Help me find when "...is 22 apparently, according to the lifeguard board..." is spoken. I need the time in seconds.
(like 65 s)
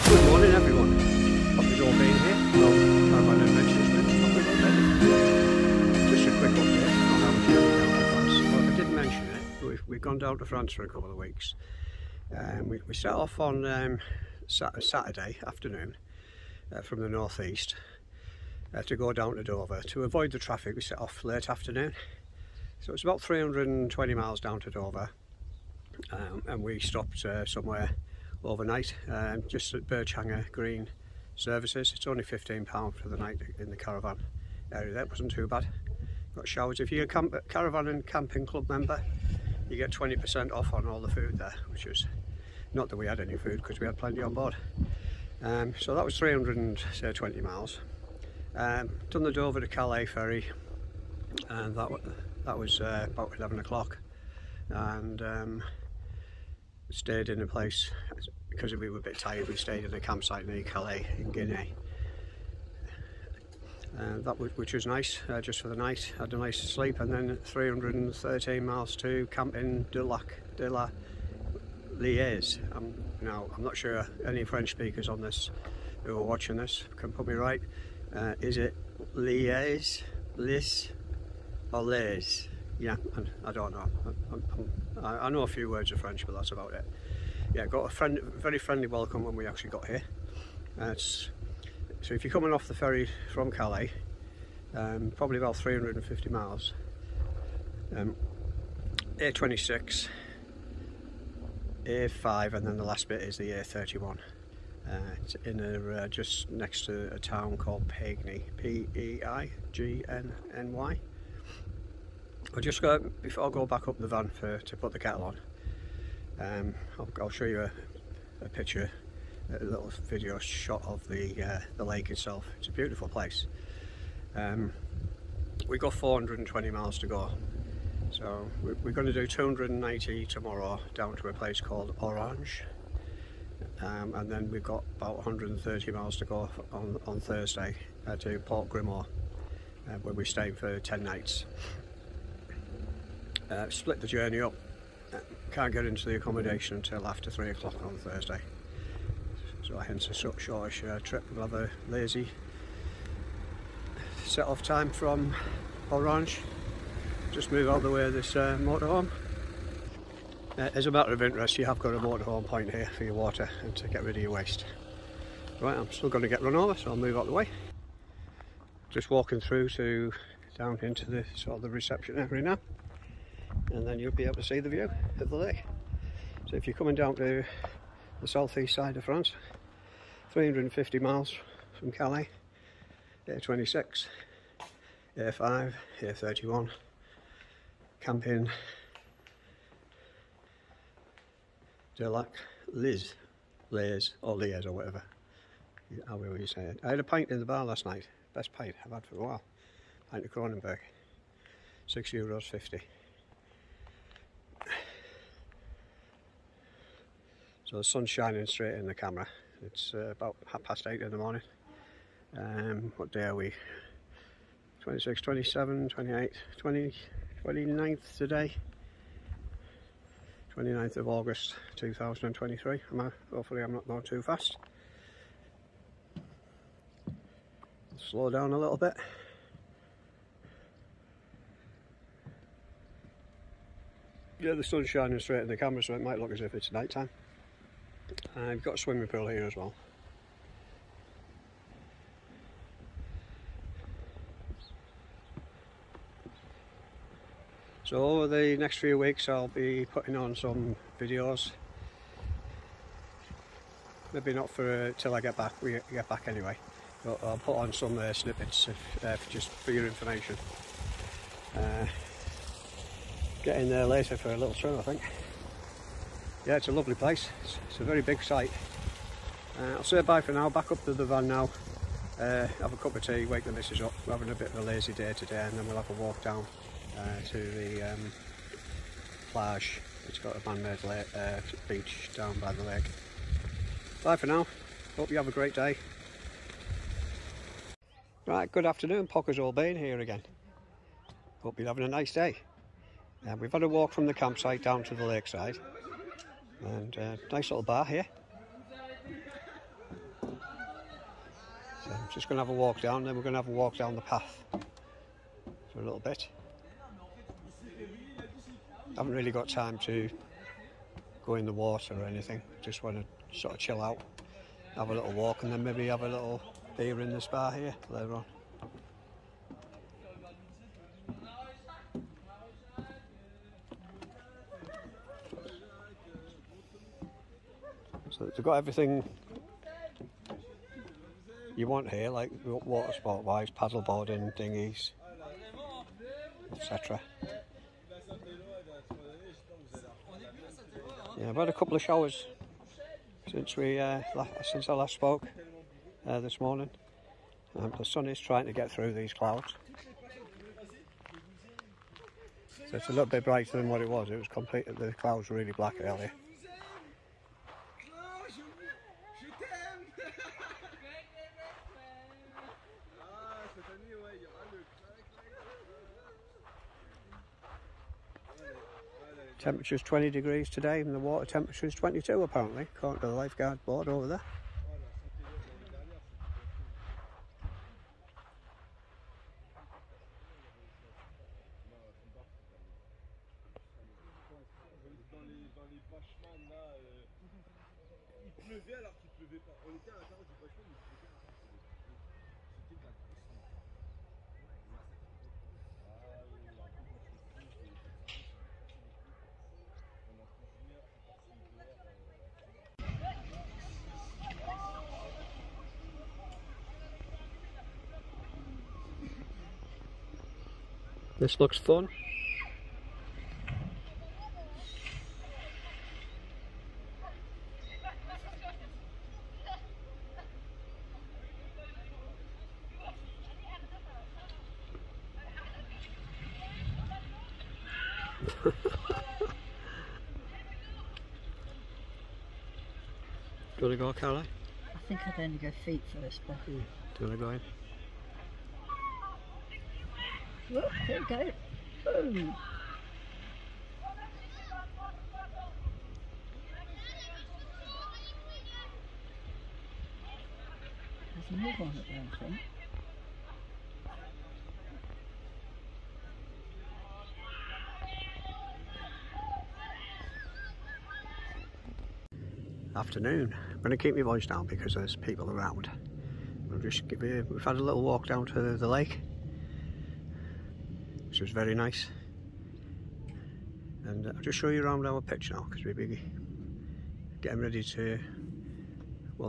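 371 s.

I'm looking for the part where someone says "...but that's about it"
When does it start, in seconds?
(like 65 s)
86 s.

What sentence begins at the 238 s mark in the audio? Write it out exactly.
Uh, we've got a swimming pool here as well.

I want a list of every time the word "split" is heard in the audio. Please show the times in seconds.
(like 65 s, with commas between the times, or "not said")
143 s.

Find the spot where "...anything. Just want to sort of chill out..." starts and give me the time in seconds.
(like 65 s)
312 s.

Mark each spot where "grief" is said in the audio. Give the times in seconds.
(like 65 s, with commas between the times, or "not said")
not said.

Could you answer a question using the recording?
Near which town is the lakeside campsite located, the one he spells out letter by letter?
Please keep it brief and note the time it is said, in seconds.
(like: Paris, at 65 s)
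Peigney, at 107 s.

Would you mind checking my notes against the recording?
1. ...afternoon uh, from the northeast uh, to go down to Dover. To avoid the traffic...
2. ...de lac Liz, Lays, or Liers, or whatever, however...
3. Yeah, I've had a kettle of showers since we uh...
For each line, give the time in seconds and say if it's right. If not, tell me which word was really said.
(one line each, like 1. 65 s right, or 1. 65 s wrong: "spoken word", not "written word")
1. 15 s right
2. 191 s right
3. 341 s wrong: "couple", not "kettle".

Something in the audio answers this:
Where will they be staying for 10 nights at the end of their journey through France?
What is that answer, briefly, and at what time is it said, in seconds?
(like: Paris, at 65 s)
Port Grimaud, at 138 s.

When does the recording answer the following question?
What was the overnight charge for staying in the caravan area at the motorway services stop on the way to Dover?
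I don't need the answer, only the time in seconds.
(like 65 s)
32 s.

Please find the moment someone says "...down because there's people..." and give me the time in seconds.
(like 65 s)
464 s.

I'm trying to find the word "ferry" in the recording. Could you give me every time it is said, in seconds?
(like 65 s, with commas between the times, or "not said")
50 s, 92 s.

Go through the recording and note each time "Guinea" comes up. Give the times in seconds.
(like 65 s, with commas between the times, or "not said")
61 s.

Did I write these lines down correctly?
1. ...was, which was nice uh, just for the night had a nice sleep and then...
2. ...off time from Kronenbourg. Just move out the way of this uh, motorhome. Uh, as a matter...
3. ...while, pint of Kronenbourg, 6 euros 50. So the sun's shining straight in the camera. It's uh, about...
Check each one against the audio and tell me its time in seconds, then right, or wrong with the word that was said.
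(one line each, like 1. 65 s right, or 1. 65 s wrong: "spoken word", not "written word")
1. 64 s right
2. 154 s wrong: "Orange", not "Kronenbourg"
3. 199 s right.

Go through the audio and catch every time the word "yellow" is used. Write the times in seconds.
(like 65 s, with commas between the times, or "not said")
not said.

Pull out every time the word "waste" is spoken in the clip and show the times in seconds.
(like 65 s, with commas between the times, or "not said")
164 s.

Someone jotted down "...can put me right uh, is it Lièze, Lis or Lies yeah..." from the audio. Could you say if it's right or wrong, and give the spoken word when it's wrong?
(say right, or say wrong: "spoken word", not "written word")
right.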